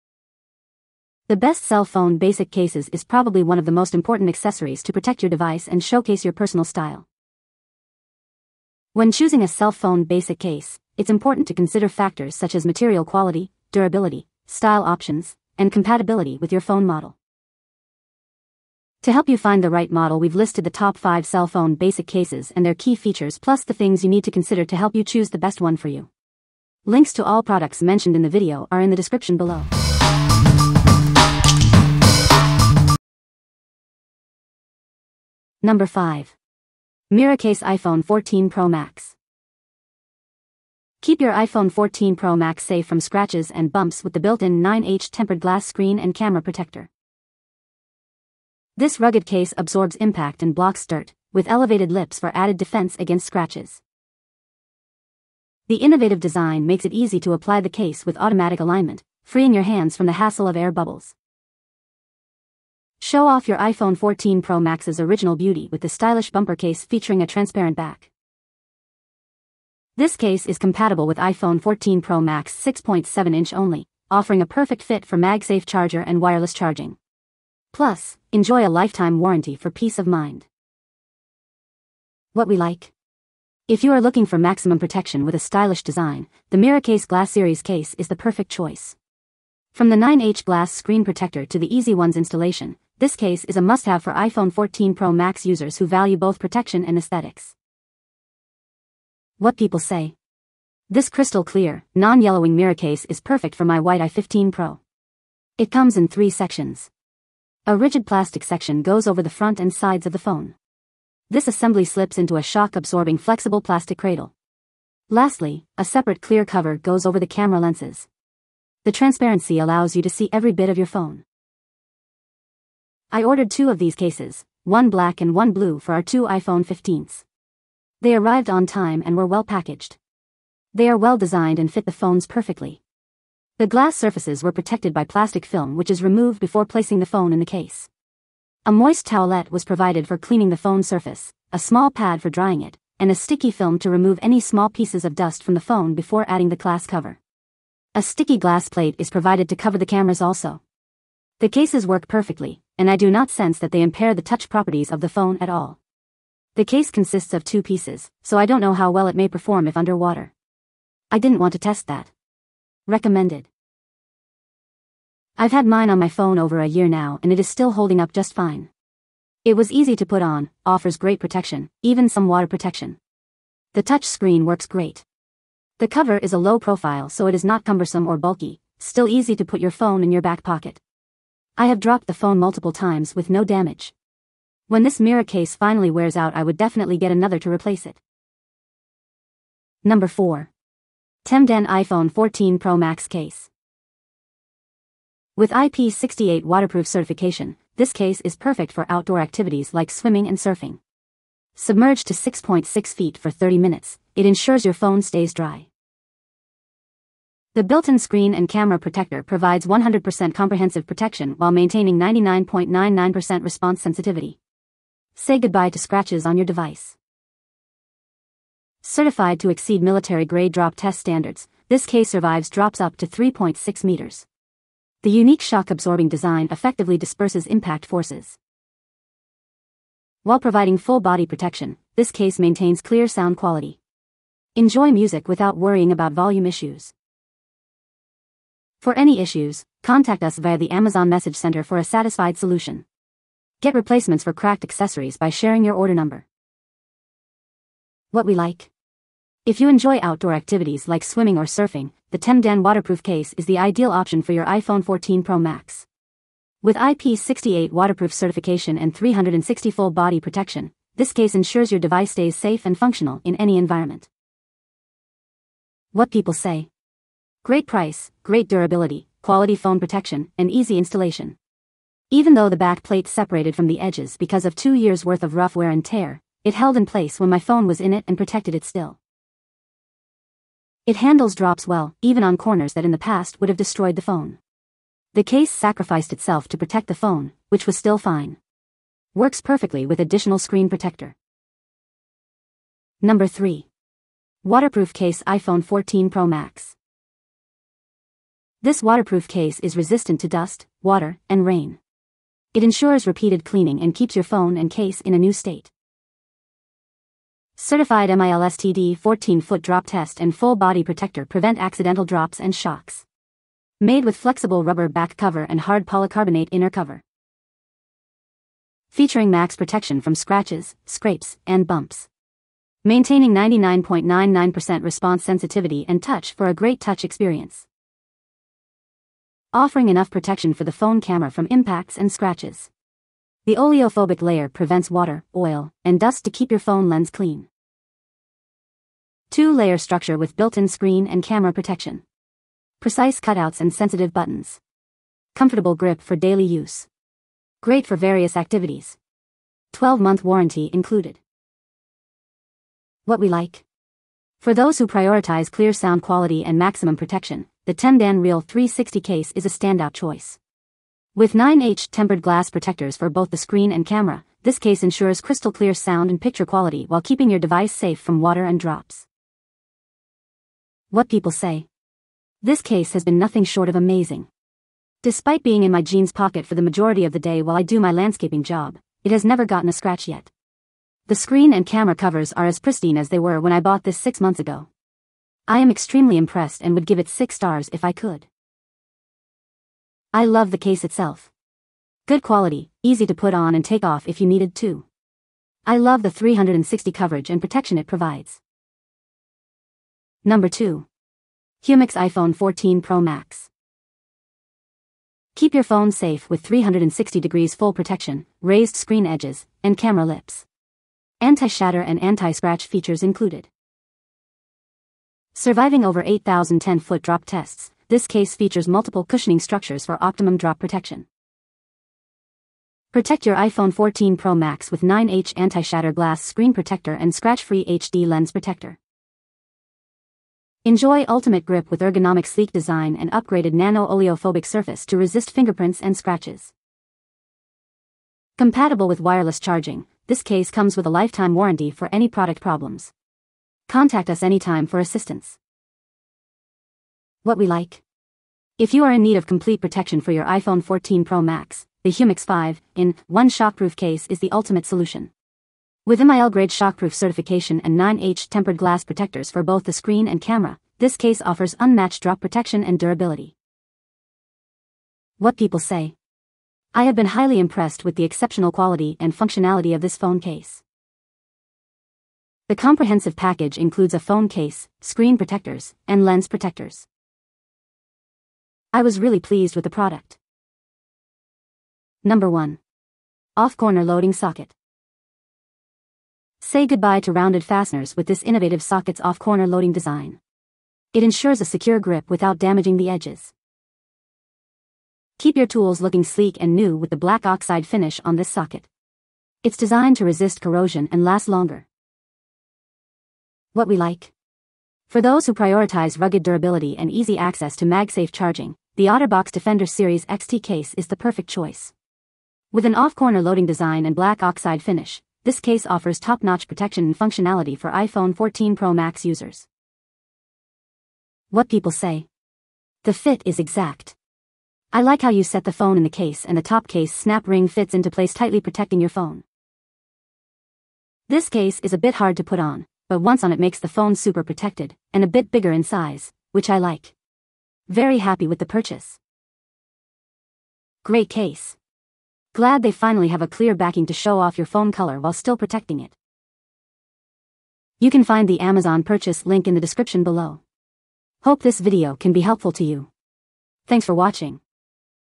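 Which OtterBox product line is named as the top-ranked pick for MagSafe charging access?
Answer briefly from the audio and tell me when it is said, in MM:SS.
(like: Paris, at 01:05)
Defender Series XT, at 08:29.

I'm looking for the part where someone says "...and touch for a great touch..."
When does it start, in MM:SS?
05:25.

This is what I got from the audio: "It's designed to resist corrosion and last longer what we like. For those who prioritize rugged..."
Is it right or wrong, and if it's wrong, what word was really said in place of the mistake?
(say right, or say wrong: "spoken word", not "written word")
right.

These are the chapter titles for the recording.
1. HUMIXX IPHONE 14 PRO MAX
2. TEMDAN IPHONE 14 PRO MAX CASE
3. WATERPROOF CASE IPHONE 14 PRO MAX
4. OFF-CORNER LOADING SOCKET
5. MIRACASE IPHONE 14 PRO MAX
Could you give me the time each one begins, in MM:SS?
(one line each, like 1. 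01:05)
1. 06:38
2. 03:08
3. 04:51
4. 08:00
5. 00:34.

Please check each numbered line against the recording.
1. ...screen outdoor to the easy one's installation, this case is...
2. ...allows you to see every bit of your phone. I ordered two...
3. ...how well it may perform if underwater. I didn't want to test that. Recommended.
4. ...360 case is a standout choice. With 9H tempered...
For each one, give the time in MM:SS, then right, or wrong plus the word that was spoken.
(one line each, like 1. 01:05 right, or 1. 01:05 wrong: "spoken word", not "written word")
1. 01:30 wrong: "protector", not "outdoor"
2. 01:59 right
3. 02:38 right
4. 05:58 right.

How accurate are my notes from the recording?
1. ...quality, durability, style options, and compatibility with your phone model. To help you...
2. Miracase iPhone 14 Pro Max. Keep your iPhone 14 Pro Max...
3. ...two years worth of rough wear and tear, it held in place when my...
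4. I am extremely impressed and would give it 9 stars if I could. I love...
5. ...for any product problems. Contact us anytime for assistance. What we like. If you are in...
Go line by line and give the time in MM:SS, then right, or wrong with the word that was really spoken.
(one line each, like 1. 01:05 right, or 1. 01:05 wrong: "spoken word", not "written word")
1. 00:13 right
2. 00:37 right
3. 04:34 right
4. 06:25 wrong: "6", not "9"
5. 07:21 right.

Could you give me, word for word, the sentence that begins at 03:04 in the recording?
When this Miracase finally wears out I would definitely get another to replace it.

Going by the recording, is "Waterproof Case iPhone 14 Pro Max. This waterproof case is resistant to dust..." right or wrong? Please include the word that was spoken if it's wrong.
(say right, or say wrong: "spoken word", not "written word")
right.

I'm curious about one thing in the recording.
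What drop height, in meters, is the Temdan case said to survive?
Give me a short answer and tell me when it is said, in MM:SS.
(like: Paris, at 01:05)
3.6 meters, at 03:43.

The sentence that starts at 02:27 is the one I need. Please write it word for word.
A sticky glass plate is provided to cover the cameras also.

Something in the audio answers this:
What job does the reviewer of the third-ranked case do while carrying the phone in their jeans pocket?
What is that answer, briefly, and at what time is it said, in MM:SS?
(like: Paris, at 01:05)
Landscaping, at 06:17.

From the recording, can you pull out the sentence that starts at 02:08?
They arrived on time and were well packaged.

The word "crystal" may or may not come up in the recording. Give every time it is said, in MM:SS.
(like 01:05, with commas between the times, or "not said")
01:41, 06:05.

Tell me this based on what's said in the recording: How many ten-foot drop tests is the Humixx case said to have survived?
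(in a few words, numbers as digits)
8,000.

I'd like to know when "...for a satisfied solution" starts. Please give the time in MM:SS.
04:01.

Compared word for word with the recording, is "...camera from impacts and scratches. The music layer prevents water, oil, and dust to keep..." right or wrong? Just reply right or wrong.
wrong.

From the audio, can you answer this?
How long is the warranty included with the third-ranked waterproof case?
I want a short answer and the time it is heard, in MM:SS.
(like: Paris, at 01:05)
12 months, at 05:49.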